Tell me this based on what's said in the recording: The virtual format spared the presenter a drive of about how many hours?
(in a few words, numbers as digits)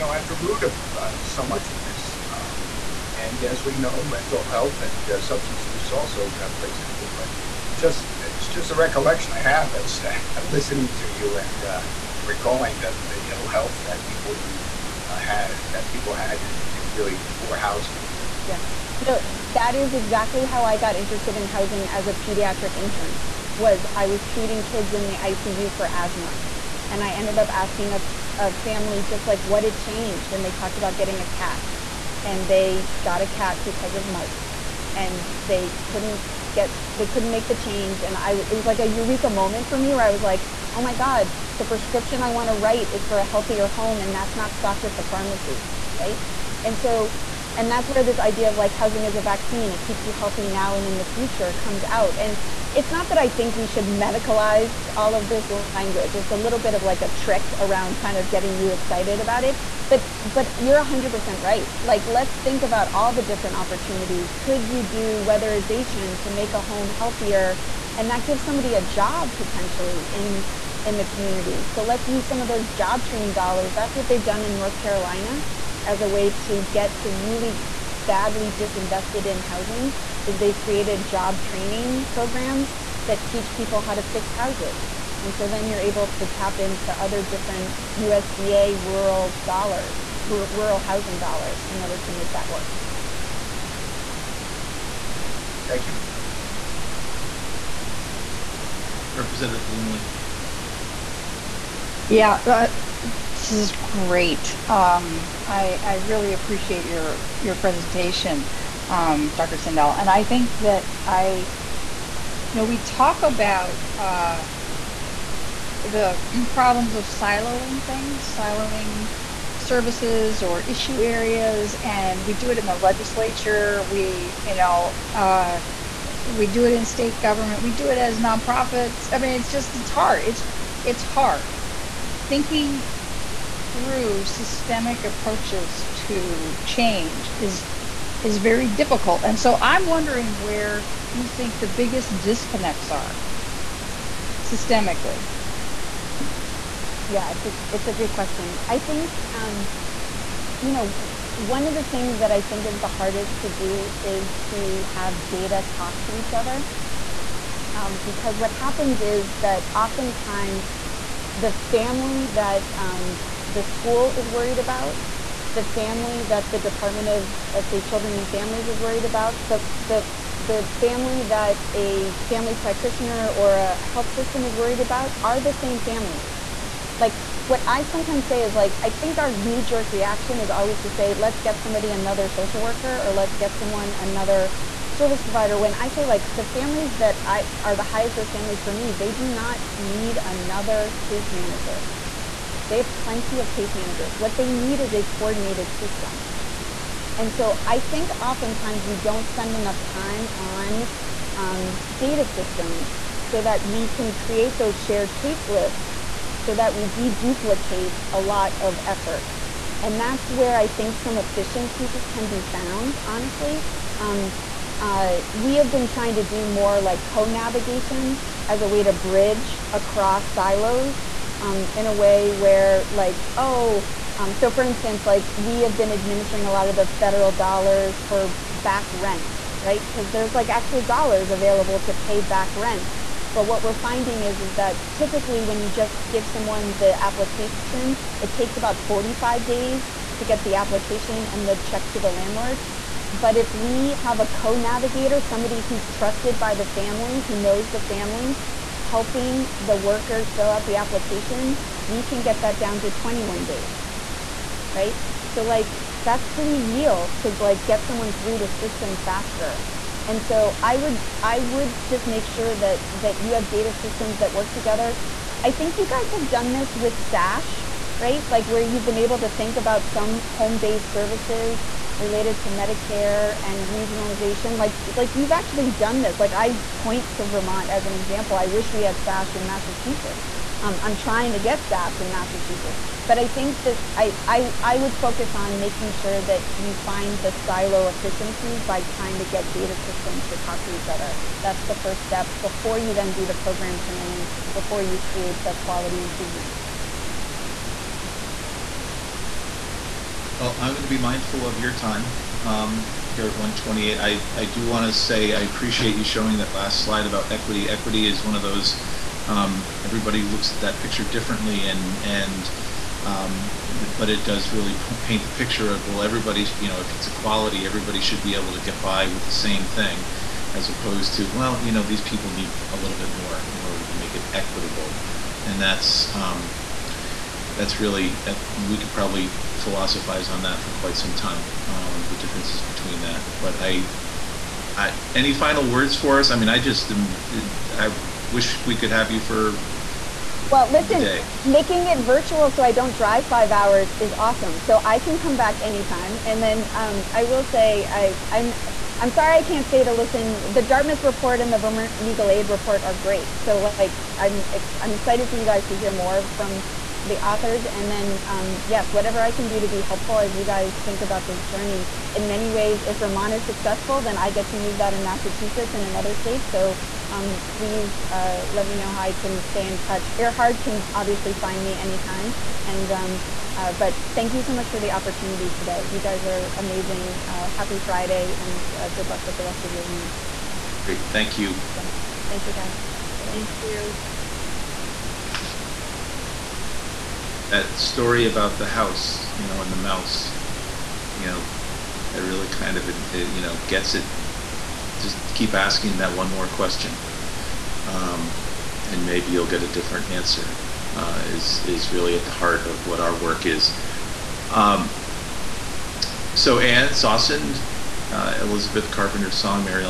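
5 hours.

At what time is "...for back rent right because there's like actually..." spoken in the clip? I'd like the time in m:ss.
3:48.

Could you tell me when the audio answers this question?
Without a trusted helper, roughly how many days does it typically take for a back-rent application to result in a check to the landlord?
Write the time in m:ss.
3:58.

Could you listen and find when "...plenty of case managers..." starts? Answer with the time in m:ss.
3:12.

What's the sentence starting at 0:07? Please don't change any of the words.
But just it's just a recollection I have as uh, yeah.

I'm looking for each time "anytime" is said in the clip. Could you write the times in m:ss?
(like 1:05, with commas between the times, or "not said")
5:45, 6:11.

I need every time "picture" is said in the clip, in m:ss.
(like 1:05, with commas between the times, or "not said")
5:10, 5:15.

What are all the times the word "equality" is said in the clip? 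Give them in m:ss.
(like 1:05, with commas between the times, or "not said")
5:17.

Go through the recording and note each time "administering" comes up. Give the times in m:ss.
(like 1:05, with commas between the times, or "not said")
3:45.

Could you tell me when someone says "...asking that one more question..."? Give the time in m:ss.
6:35.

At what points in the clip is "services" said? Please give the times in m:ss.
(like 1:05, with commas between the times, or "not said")
1:59, 3:04, 4:30.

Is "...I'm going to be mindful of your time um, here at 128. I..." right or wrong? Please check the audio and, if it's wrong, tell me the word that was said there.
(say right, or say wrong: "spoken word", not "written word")
right.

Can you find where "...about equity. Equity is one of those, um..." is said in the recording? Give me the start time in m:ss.
5:07.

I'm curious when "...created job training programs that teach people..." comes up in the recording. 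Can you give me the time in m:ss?
1:20.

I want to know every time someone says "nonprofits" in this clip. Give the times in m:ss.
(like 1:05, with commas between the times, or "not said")
2:08.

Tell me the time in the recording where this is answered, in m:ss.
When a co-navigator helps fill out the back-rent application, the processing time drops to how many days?
4:12.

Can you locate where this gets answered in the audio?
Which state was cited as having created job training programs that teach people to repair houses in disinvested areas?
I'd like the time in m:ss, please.
1:14.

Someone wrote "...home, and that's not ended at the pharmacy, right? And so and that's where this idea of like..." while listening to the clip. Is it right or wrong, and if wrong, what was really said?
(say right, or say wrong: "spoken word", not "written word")
wrong: "stocked", not "ended".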